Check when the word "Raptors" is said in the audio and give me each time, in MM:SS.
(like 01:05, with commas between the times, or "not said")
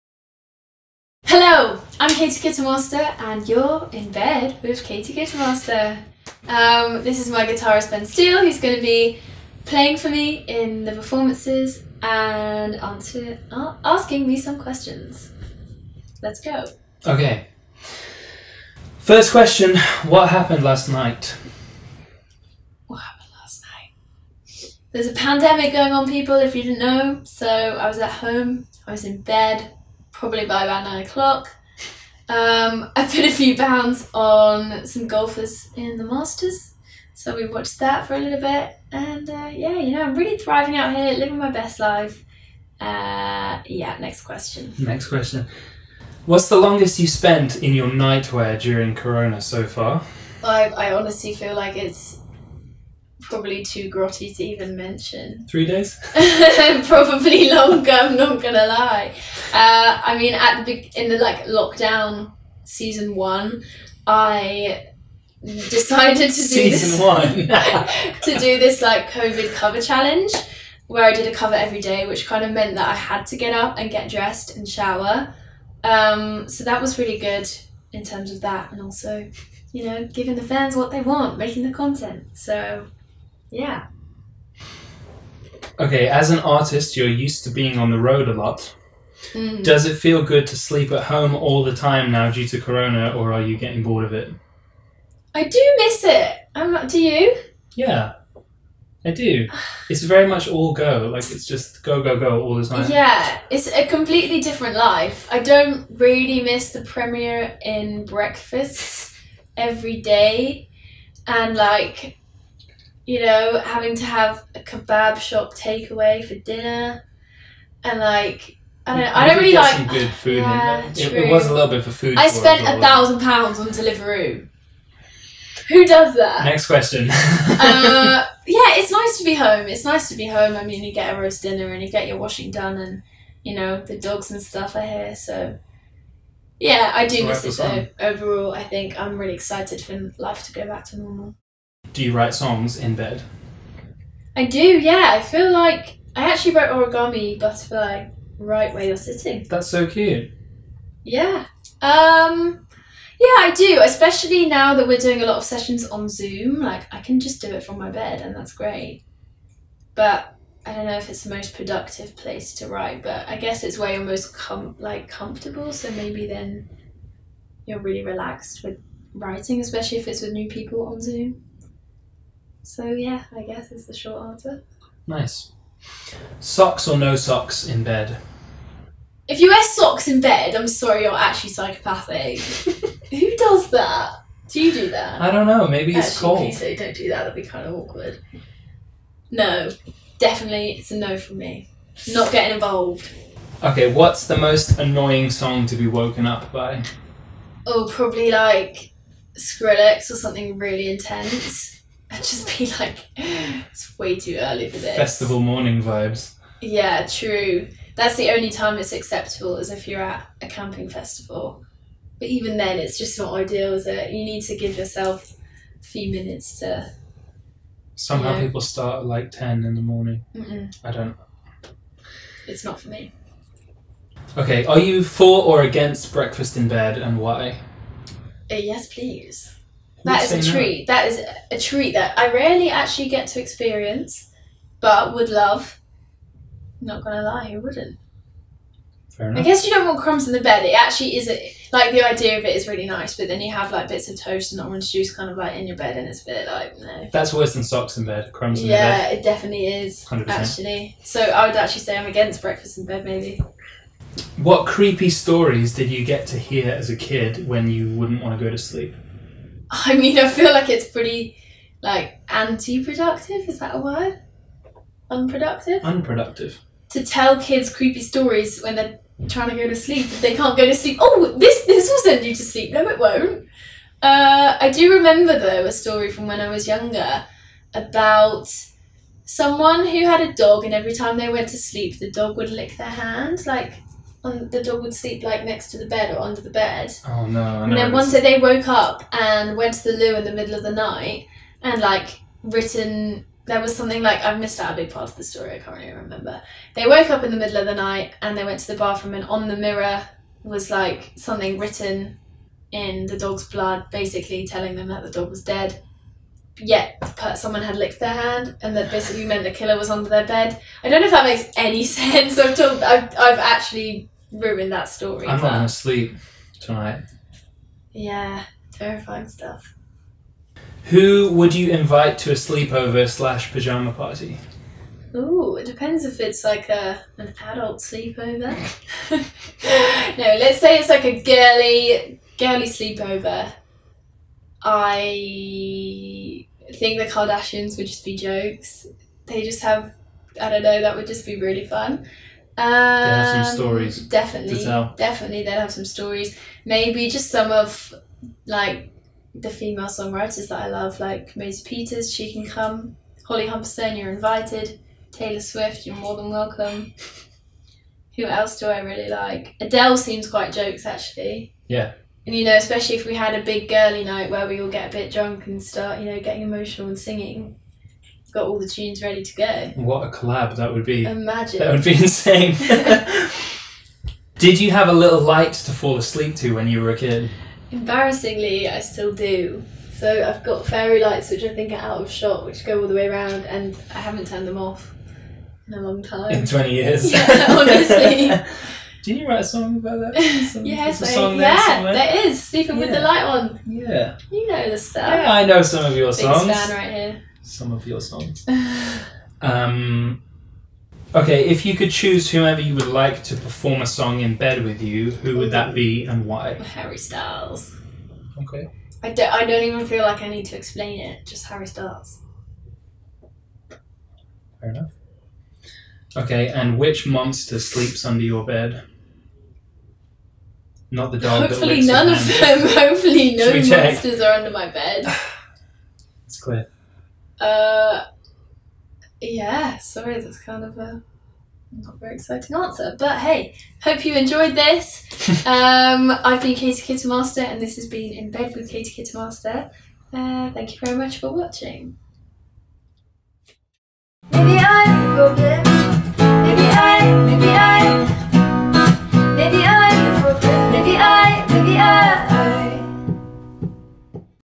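not said.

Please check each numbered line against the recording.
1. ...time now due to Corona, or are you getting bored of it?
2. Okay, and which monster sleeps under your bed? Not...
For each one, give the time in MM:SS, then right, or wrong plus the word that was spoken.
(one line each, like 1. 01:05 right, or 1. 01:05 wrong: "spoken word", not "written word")
1. 01:31 right
2. 06:56 right.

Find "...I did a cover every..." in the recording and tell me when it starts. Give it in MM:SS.
01:11.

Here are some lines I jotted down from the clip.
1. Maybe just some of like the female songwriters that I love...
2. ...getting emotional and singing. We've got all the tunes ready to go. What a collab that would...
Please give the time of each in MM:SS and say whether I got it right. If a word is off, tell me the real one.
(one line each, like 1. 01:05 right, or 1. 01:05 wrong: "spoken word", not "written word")
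1. 05:46 right
2. 06:06 right.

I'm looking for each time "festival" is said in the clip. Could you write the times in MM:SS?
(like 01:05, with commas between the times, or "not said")
03:24, 03:30.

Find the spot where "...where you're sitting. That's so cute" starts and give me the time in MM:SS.
02:28.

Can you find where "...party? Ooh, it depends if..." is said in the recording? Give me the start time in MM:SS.
05:23.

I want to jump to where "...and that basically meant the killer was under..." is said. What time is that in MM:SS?
05:08.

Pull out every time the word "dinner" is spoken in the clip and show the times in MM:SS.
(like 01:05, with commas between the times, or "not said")
01:56, 02:11.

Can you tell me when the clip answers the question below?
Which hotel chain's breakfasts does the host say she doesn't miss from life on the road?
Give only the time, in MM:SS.
01:46.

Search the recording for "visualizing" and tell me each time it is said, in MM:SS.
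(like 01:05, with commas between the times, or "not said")
not said.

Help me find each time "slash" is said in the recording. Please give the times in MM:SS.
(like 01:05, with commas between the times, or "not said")
05:23.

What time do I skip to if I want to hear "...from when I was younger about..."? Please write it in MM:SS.
04:36.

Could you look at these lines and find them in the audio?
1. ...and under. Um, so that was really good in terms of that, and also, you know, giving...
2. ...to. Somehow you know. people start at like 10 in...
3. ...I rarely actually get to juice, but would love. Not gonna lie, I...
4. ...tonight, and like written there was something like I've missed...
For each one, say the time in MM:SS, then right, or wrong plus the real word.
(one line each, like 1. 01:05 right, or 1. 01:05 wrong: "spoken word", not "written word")
1. 01:14 wrong: "shower", not "under"
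2. 03:36 right
3. 03:52 wrong: "experience", not "juice"
4. 04:50 wrong: "night", not "tonight".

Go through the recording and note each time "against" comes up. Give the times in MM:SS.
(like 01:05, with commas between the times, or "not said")
03:45, 04:12.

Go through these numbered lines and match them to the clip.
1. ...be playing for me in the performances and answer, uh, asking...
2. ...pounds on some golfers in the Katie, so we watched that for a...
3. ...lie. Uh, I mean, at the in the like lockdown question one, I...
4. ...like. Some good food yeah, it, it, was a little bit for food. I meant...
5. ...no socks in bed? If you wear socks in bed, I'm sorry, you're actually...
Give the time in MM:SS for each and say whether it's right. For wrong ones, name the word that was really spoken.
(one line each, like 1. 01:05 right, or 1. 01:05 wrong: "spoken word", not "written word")
1. 00:08 right
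2. 00:33 wrong: "Masters", not "Katie"
3. 00:58 wrong: "season", not "question"
4. 01:59 wrong: "spent", not "meant"
5. 02:56 right.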